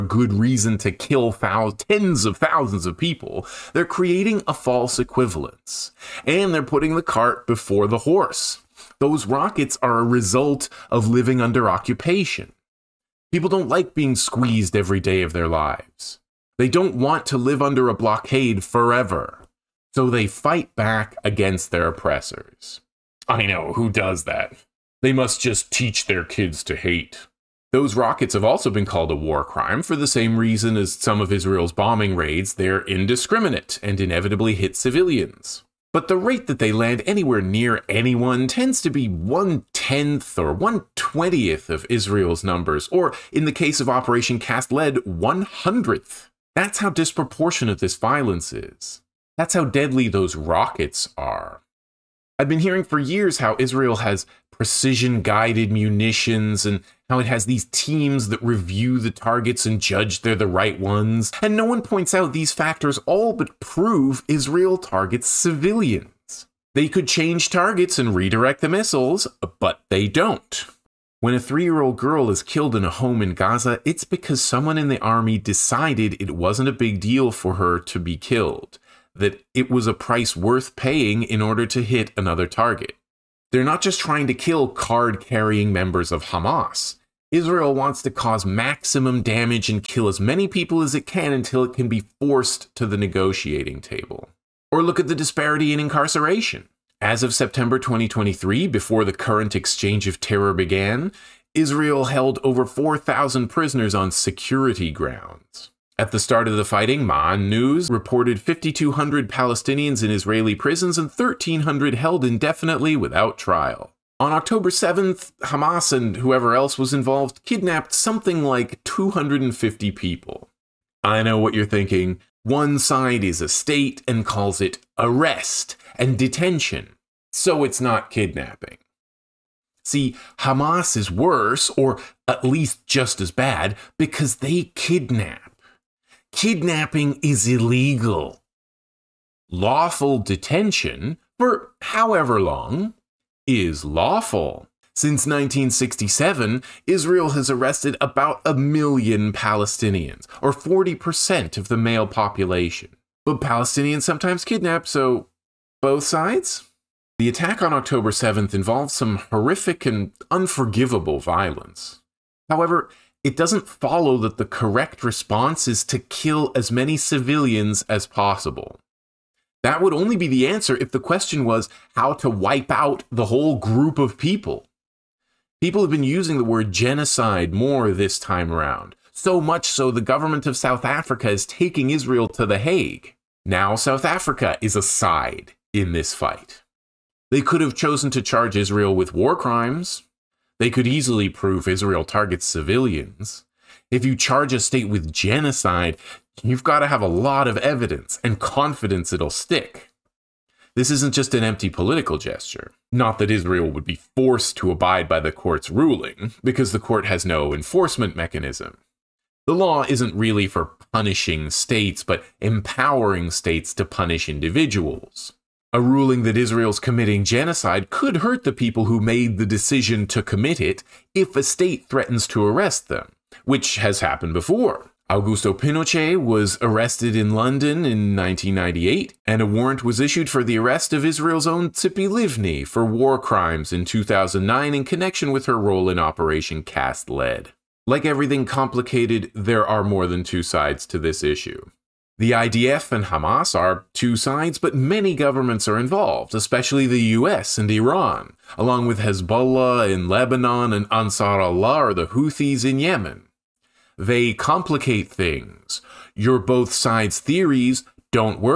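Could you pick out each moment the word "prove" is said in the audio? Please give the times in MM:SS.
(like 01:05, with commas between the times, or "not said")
01:03, 03:11.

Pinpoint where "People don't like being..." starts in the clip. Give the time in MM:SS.
00:13.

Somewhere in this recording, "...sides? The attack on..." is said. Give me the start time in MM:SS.
02:36.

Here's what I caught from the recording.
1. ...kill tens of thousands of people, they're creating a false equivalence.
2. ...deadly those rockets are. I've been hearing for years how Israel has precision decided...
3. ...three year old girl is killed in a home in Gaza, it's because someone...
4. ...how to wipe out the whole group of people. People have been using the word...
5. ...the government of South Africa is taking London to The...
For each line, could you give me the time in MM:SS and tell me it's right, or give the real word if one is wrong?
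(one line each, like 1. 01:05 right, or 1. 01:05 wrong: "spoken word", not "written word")
1. 00:00 right
2. 00:49 wrong: "guided", not "decided"
3. 01:11 right
4. 02:51 right
5. 02:59 wrong: "Israel", not "London".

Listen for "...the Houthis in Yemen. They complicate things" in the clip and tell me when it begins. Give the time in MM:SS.
04:11.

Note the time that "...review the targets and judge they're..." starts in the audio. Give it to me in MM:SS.
00:58.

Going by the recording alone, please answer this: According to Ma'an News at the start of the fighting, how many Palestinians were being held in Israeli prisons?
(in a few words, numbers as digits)
5,200.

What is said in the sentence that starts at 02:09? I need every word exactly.
See, Hamas is worse, or at least just as bad, because they kidnap.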